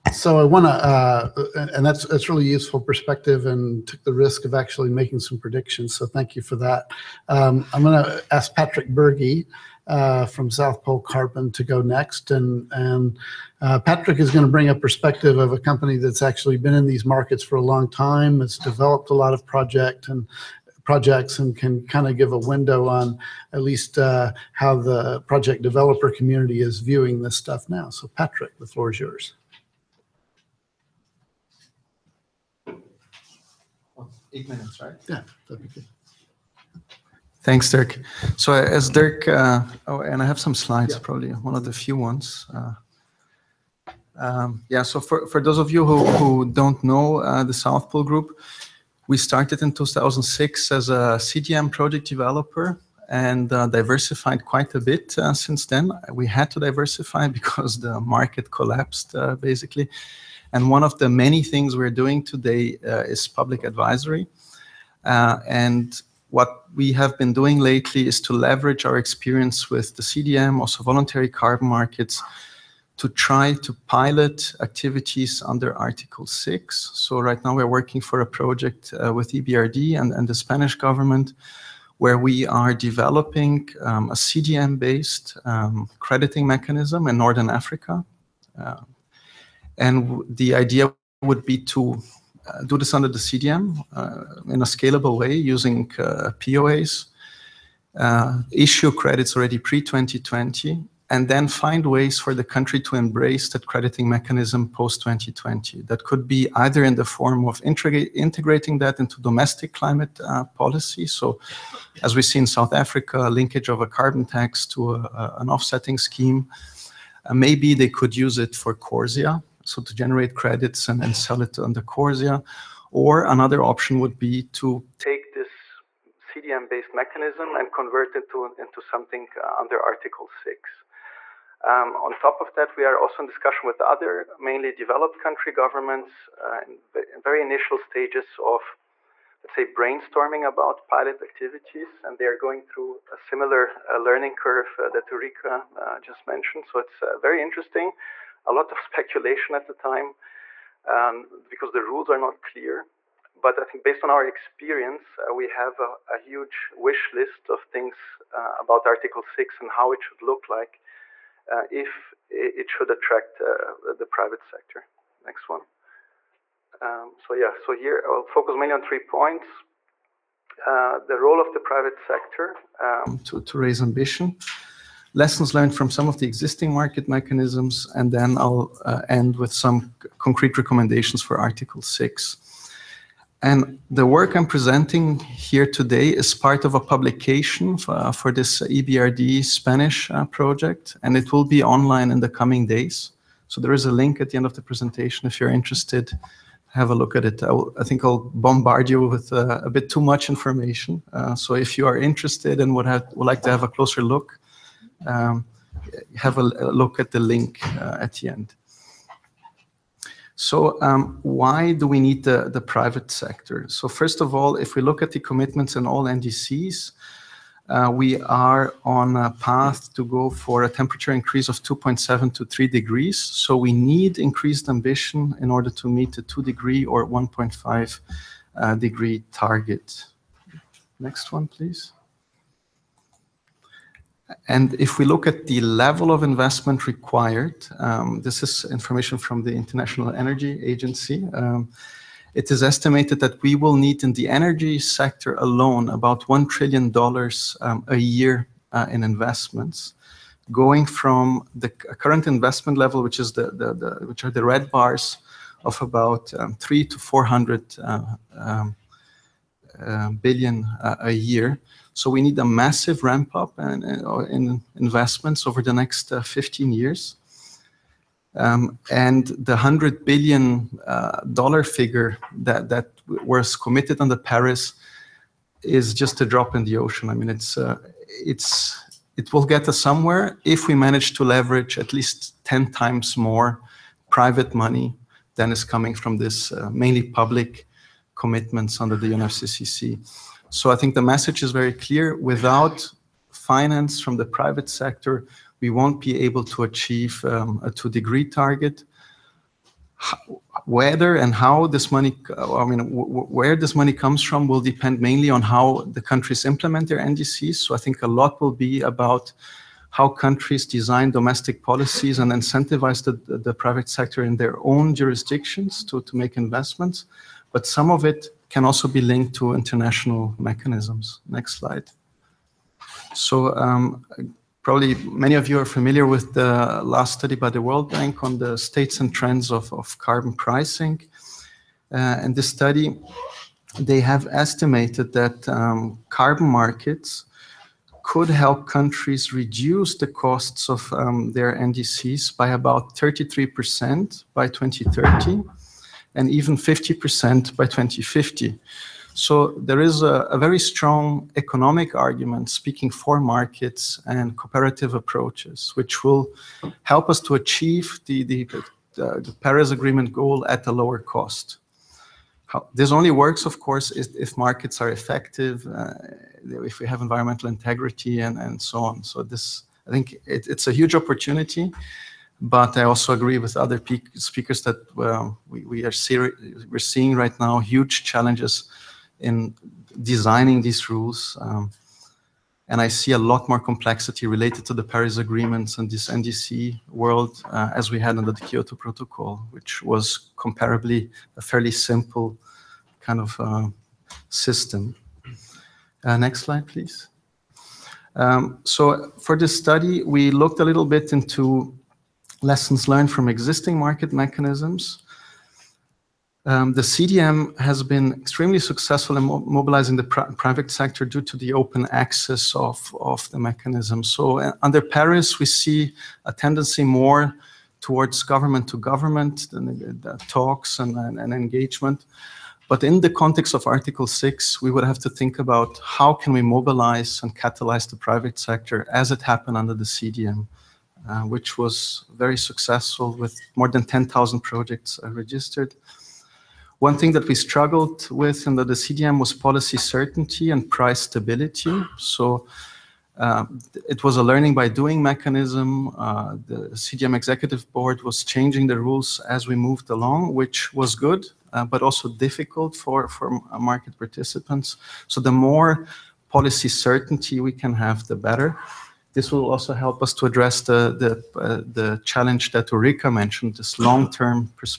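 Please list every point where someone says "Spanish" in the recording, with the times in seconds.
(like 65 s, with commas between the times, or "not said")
80 s, 189 s.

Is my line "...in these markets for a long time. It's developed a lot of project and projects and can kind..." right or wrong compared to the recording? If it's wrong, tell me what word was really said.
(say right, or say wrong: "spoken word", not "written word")
right.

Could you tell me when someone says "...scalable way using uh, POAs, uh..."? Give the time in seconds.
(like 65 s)
94 s.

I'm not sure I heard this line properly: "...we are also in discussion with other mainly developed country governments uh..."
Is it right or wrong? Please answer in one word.
right.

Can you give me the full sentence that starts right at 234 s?
And if we look at the level of investment required, um, this is information from the International Energy Agency.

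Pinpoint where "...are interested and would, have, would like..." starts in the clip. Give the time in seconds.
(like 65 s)
201 s.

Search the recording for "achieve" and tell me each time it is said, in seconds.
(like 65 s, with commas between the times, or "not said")
296 s, 357 s.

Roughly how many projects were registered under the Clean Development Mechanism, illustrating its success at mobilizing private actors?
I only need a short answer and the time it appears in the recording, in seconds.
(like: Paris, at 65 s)
more than 10,000, at 433 s.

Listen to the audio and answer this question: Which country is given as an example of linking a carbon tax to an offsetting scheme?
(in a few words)
South Africa.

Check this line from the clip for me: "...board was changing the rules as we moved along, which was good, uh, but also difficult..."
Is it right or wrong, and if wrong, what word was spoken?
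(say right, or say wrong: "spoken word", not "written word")
right.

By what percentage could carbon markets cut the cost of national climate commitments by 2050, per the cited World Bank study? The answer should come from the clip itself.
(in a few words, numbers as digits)
50%.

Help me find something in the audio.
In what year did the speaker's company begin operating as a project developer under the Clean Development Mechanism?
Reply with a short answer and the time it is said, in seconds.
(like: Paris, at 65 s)
2006, at 49 s.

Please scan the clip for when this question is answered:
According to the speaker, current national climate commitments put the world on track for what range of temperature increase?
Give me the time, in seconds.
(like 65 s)
221 s.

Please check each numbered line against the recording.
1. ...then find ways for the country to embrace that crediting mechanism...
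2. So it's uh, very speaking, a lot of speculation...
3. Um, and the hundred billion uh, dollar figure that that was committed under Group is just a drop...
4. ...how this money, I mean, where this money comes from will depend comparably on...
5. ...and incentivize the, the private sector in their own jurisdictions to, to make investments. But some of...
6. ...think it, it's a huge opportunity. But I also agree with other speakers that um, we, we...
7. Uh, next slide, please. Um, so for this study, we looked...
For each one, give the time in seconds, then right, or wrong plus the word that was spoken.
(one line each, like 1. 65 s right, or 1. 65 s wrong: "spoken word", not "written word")
1. 101 s right
2. 146 s wrong: "interesting", not "speaking"
3. 268 s wrong: "Paris", not "Group"
4. 301 s wrong: "mainly", not "comparably"
5. 312 s right
6. 369 s right
7. 396 s right.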